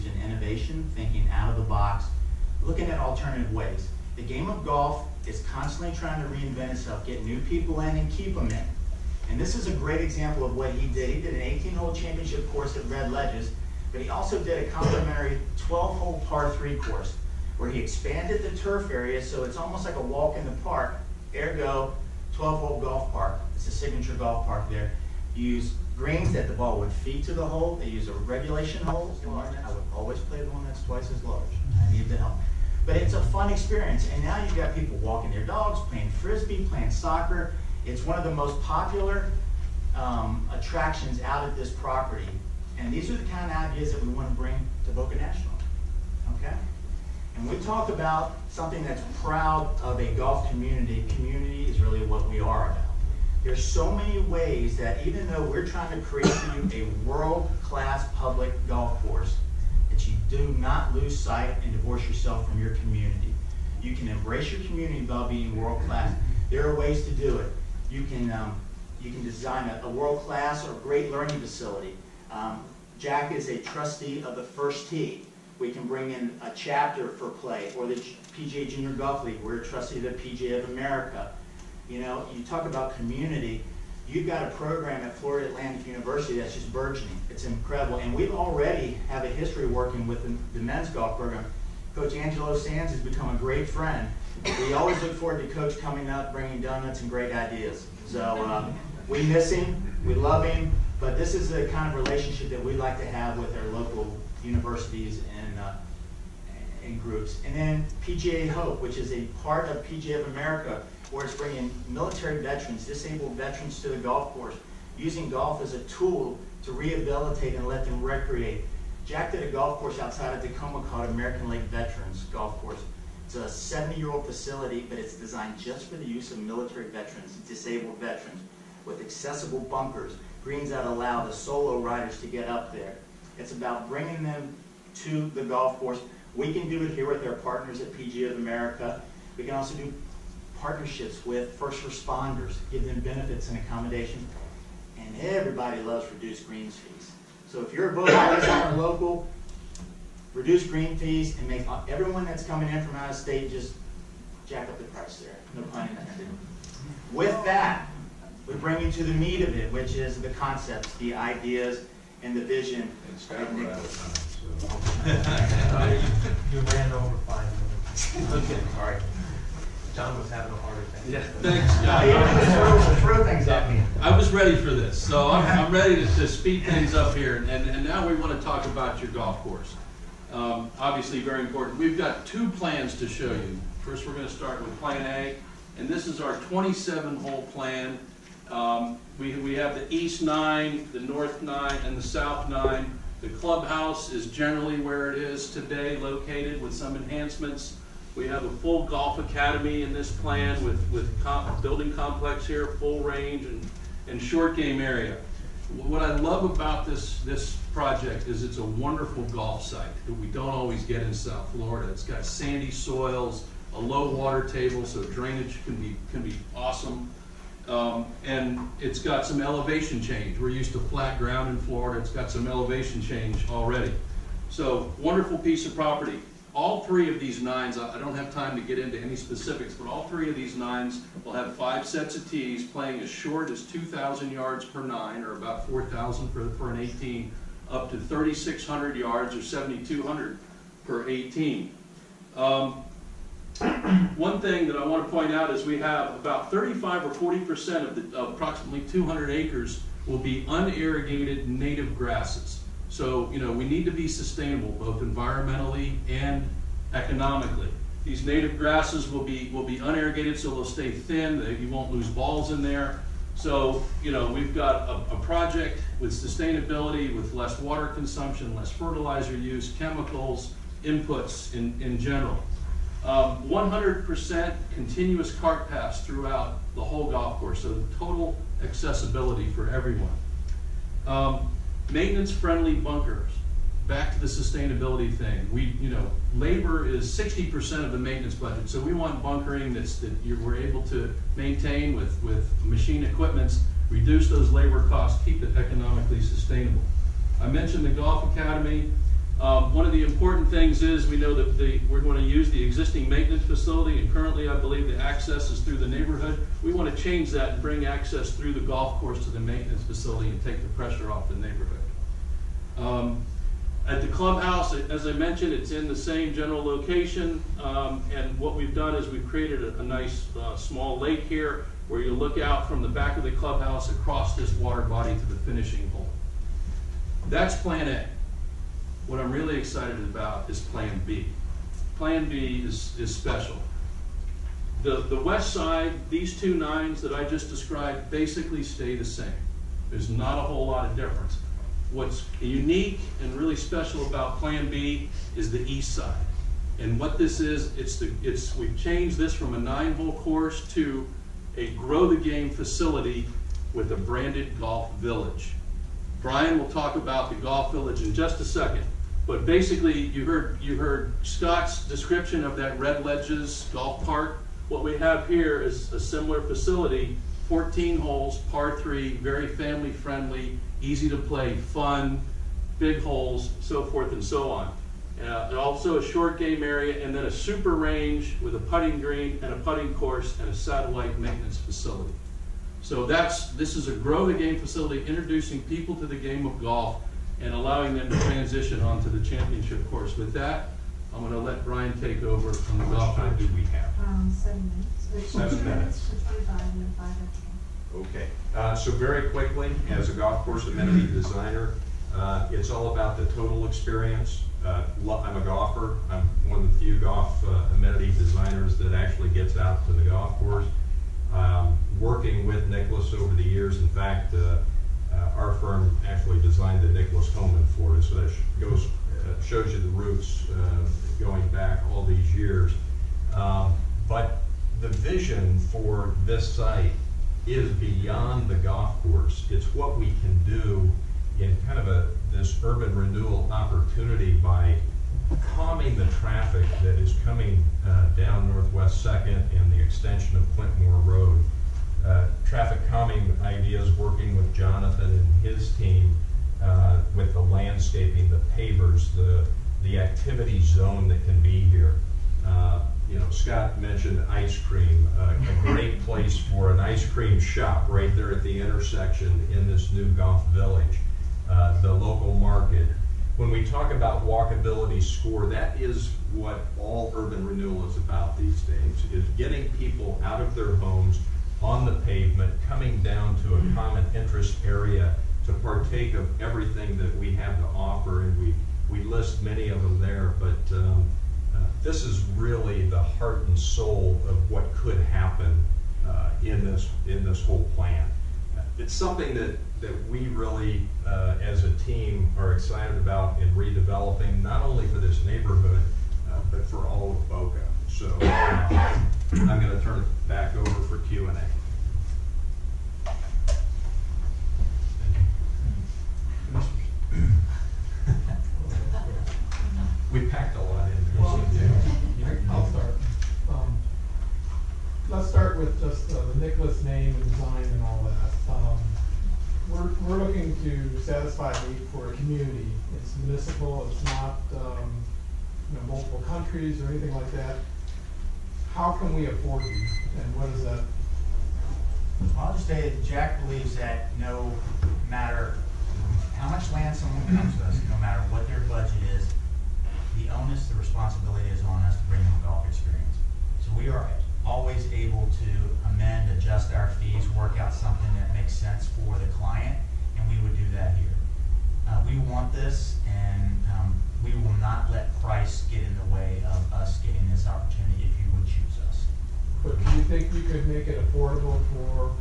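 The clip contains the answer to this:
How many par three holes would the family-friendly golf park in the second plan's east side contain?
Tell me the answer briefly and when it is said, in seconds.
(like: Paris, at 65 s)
14, at 367 s.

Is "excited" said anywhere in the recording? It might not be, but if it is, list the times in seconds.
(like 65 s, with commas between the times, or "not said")
329 s, 492 s.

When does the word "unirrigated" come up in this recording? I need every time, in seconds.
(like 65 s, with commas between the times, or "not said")
250 s, 259 s.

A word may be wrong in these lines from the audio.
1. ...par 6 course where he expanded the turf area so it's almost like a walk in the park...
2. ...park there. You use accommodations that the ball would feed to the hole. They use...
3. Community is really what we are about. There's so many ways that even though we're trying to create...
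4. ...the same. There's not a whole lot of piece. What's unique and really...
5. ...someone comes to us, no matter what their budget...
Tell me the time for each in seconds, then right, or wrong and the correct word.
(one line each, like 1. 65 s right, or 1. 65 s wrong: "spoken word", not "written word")
1. 16 s wrong: "3", not "6"
2. 24 s wrong: "greens", not "accommodations"
3. 51 s right
4. 338 s wrong: "difference", not "piece"
5. 536 s right.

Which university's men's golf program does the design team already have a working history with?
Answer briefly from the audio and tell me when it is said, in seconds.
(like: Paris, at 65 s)
Florida Atlantic University, at 85 s.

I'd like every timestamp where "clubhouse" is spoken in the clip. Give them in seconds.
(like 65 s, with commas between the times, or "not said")
193 s, 314 s, 323 s.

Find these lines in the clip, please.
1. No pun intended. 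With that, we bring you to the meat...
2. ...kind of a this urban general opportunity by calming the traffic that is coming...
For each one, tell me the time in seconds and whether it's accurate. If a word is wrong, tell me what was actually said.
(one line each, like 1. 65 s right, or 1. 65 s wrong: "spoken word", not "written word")
1. 155 s right
2. 431 s wrong: "renewal", not "general".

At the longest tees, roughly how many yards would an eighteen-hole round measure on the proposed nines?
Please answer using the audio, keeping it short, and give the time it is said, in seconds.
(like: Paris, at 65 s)
7,200, at 239 s.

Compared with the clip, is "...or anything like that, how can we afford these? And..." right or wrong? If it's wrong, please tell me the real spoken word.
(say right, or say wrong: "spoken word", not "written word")
right.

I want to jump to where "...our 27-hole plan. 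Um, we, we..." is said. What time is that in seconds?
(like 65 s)
186 s.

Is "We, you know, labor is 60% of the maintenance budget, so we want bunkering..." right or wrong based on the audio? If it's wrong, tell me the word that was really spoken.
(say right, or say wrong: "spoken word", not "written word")
right.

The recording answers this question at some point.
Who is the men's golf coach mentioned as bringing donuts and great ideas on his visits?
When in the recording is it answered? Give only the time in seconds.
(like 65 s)
92 s.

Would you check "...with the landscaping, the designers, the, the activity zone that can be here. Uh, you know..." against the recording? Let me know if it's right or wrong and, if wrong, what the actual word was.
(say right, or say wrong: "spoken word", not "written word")
wrong: "pavers", not "designers".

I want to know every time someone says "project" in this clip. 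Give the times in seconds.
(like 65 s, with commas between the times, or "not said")
207 s, 265 s.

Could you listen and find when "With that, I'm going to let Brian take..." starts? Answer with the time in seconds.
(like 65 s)
390 s.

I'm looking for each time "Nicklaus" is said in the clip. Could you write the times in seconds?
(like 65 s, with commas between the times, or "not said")
412 s, 416 s.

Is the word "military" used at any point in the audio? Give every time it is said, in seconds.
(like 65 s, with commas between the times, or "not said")
111 s, 126 s.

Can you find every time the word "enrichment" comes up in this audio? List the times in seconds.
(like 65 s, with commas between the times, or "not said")
not said.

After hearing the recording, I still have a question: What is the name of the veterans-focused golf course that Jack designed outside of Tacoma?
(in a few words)
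American Lake Veterans Golf Course.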